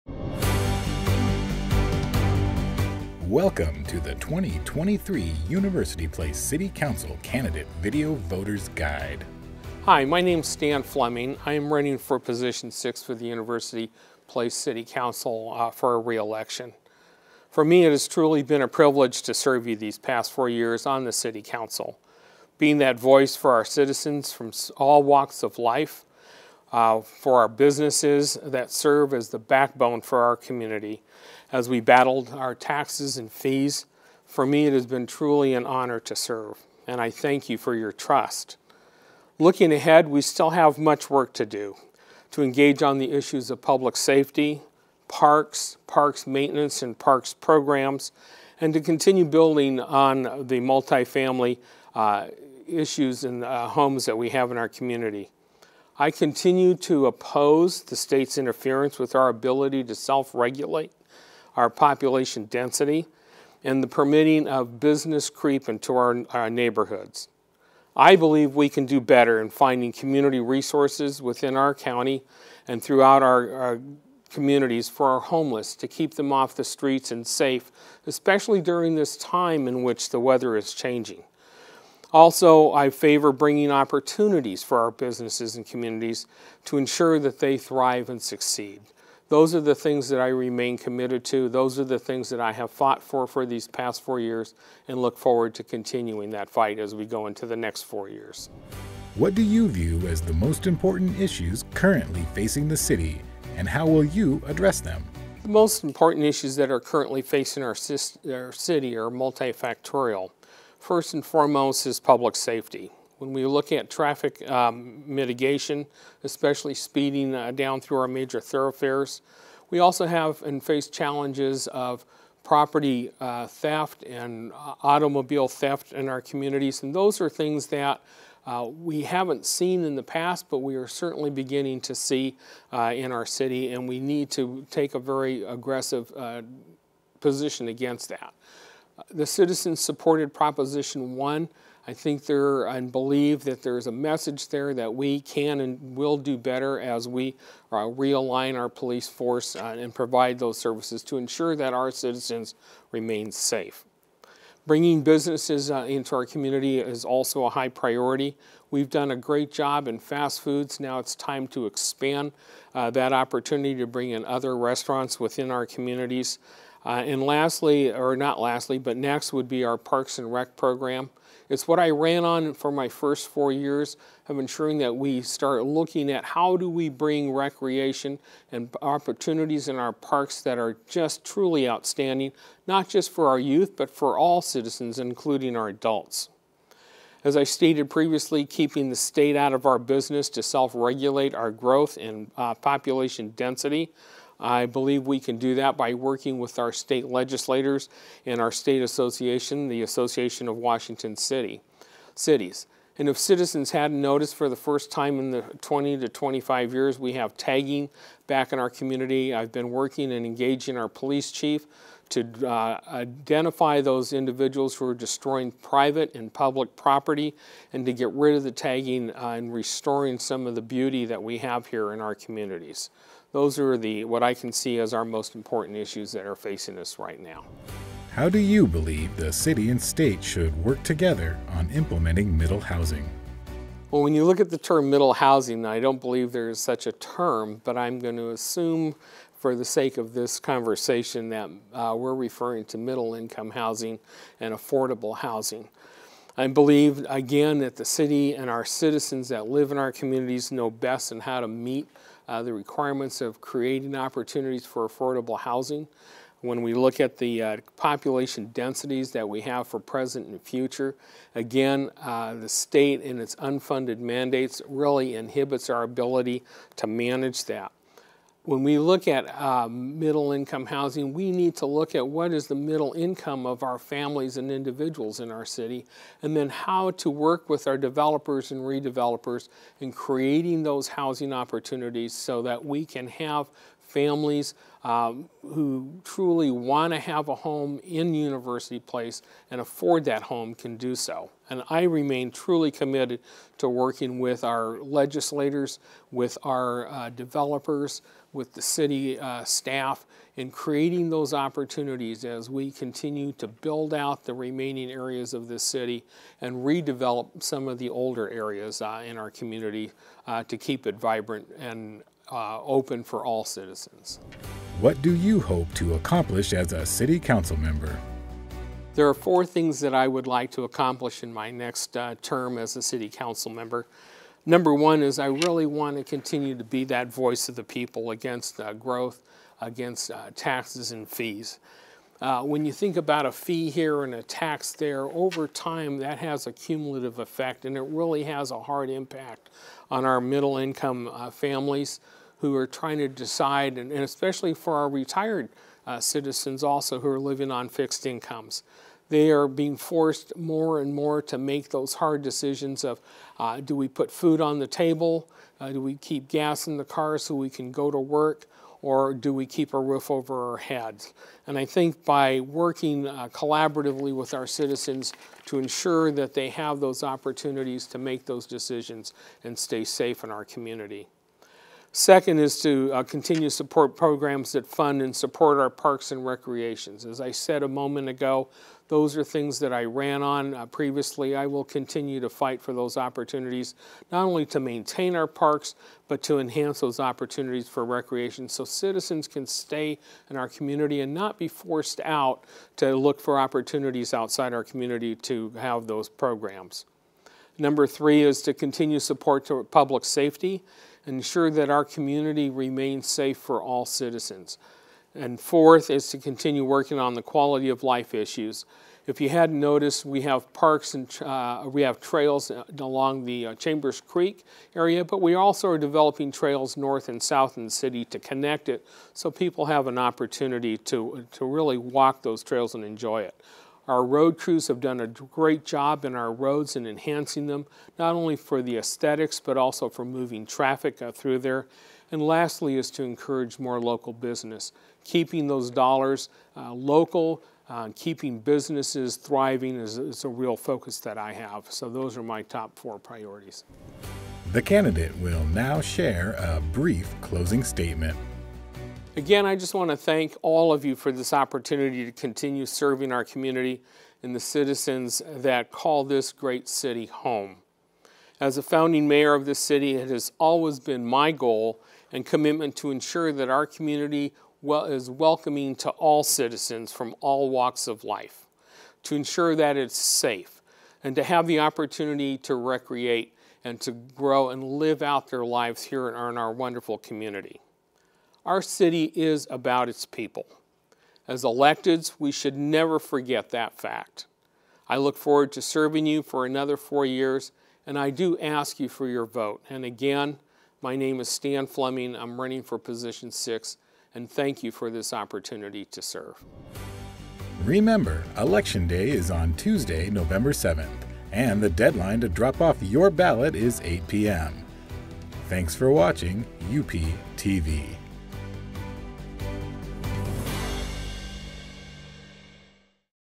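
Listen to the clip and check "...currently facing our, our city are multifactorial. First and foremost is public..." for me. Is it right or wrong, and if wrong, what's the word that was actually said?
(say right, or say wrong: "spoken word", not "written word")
right.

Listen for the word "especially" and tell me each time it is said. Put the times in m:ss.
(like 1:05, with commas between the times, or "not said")
1:18, 1:56, 5:44.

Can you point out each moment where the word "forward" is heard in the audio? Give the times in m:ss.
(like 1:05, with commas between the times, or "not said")
1:35, 8:05.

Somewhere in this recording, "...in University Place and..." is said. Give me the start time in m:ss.
4:47.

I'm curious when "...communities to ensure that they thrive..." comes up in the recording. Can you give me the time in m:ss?
1:25.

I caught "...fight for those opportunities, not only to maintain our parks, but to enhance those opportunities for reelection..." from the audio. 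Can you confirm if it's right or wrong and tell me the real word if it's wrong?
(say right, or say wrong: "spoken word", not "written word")
wrong: "recreation", not "reelection".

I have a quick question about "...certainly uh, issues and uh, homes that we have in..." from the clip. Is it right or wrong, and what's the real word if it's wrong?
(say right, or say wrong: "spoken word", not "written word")
wrong: "multifamily", not "certainly".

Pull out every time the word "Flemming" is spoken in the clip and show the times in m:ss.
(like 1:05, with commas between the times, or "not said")
0:10, 8:11.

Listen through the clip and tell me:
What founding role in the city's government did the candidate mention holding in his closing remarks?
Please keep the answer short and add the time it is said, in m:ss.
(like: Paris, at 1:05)
Founding mayor, at 7:38.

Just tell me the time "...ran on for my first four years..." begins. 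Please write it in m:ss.
2:51.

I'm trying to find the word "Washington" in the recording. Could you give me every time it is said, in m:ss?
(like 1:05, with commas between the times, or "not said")
3:20.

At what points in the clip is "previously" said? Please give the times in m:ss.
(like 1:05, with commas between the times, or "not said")
3:07, 6:20.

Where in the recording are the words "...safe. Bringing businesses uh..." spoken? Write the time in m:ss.
2:33.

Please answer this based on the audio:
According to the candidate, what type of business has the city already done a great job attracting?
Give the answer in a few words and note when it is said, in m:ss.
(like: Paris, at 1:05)
Fast foods, at 2:39.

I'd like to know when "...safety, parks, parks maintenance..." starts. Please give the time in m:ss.
0:43.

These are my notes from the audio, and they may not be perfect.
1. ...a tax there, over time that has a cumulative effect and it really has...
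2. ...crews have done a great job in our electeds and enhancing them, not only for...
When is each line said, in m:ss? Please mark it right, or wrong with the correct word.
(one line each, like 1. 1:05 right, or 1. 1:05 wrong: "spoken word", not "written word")
1. 5:34 right
2. 7:04 wrong: "roads", not "electeds".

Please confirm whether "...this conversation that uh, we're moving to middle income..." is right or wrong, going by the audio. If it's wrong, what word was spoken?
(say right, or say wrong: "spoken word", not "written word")
wrong: "referring", not "moving".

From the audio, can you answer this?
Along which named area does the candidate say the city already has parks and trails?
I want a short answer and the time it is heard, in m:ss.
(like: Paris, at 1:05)
Chambers Creek, at 6:53.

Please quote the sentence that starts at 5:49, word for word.
They are being forced more and more to make those hard decisions of uh, do we put food on the table?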